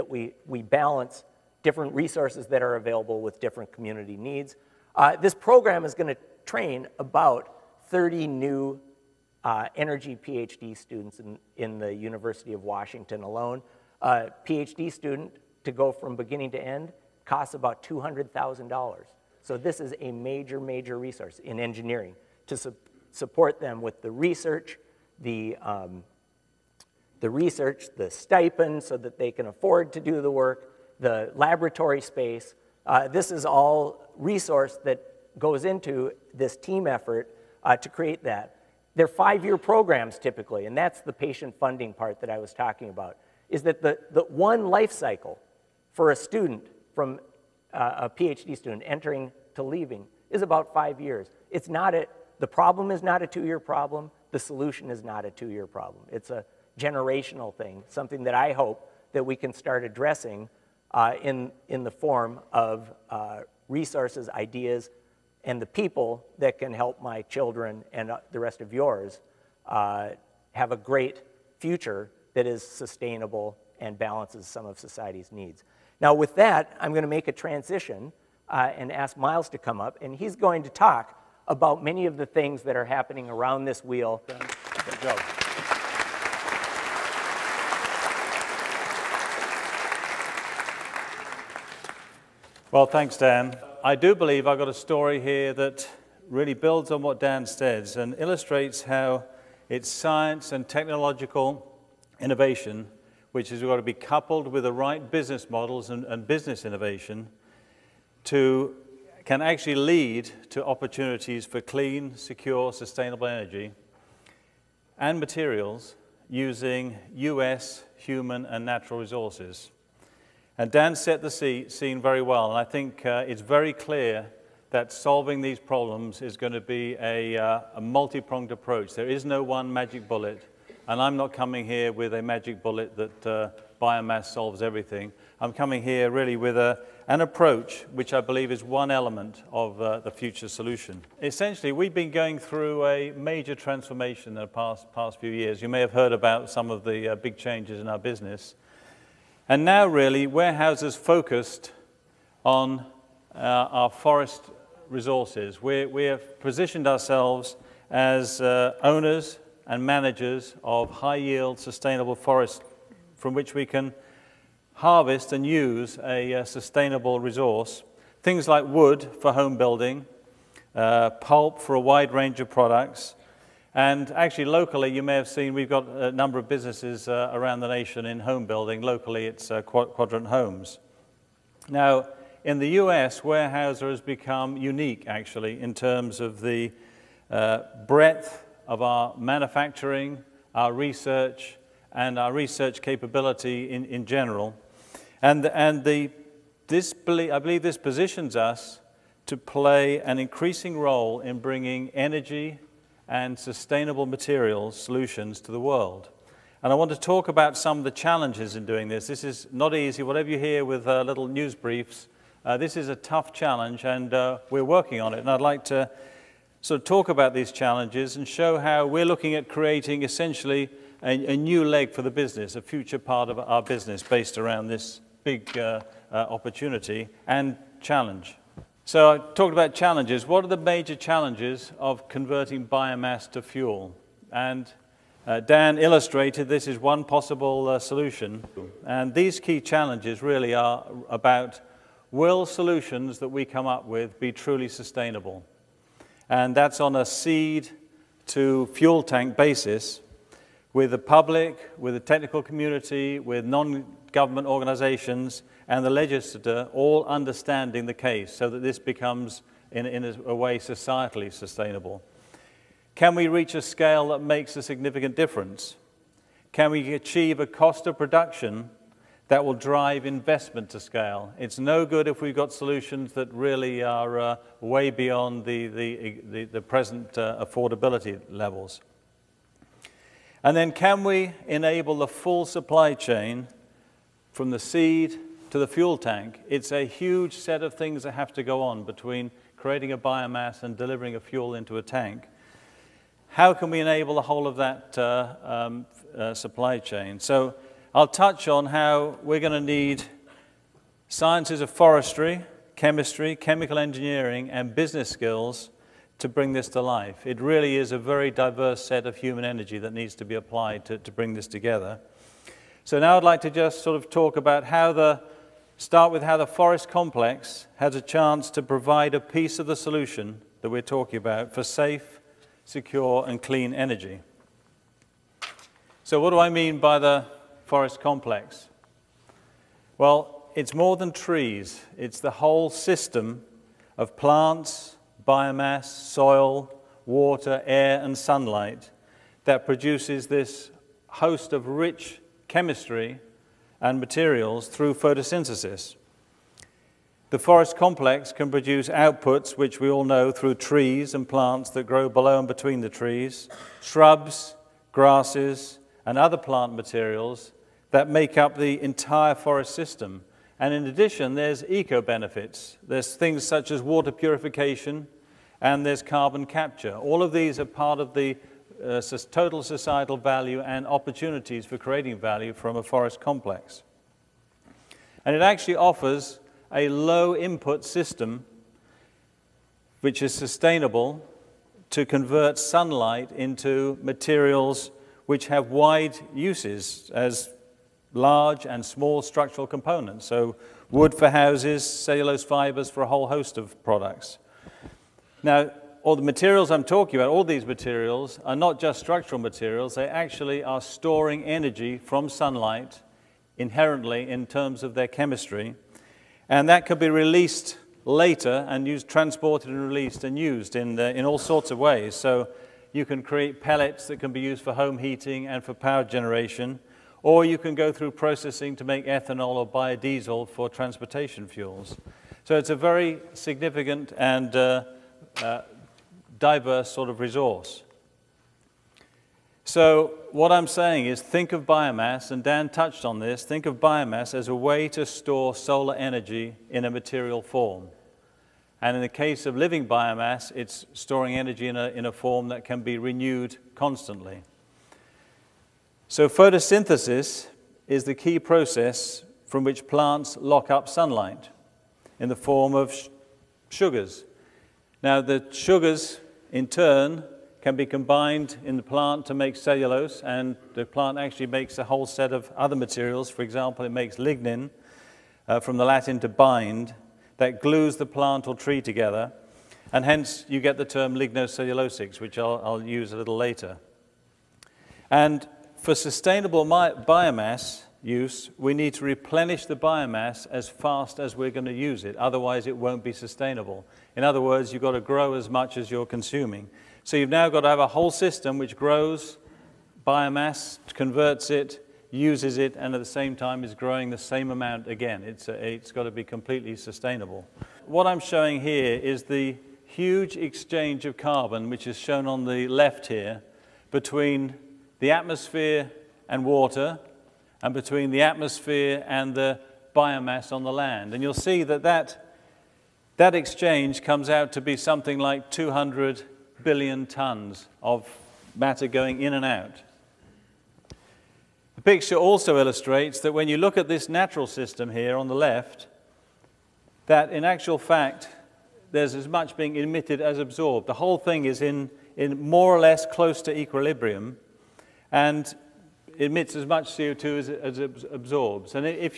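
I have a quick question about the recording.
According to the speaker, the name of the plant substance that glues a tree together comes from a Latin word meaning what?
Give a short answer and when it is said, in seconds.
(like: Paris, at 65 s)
to bind, at 466 s.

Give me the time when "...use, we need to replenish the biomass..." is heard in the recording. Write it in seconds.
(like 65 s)
478 s.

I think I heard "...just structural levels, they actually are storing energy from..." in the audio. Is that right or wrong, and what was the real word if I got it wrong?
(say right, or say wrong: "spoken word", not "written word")
wrong: "materials", not "levels".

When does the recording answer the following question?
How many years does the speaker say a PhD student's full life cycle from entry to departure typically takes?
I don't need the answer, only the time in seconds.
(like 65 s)
50 s.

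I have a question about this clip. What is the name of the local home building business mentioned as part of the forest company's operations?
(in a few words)
Quadrant Homes.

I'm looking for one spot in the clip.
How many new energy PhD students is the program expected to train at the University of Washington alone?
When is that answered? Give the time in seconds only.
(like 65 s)
7 s.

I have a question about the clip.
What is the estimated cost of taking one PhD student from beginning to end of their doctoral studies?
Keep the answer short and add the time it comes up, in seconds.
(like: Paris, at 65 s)
$200,000, at 17 s.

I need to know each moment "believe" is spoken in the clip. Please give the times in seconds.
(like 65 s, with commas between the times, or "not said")
94 s, 138 s, 197 s.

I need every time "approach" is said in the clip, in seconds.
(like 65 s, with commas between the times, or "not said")
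128 s, 137 s.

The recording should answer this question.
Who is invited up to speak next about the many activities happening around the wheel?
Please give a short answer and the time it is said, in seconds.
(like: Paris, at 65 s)
Miles, at 79 s.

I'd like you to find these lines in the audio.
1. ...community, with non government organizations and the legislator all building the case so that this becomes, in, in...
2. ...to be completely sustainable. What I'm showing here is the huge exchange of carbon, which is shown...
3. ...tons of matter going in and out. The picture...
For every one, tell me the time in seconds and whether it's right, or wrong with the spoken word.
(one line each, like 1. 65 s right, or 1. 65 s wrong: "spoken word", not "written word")
1. 252 s wrong: "understanding", not "building"
2. 496 s right
3. 517 s right.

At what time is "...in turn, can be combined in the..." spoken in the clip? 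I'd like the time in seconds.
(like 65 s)
456 s.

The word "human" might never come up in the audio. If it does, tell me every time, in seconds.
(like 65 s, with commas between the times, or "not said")
117 s, 309 s.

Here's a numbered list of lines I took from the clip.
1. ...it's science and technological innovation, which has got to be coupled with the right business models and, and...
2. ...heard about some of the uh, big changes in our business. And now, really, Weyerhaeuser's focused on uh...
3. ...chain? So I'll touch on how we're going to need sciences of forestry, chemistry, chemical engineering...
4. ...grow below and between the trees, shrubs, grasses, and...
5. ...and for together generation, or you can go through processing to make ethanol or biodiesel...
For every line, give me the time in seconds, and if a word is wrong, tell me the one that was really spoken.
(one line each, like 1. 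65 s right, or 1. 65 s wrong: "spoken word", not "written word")
1. 99 s right
2. 145 s right
3. 296 s right
4. 351 s right
5. 415 s wrong: "power", not "together".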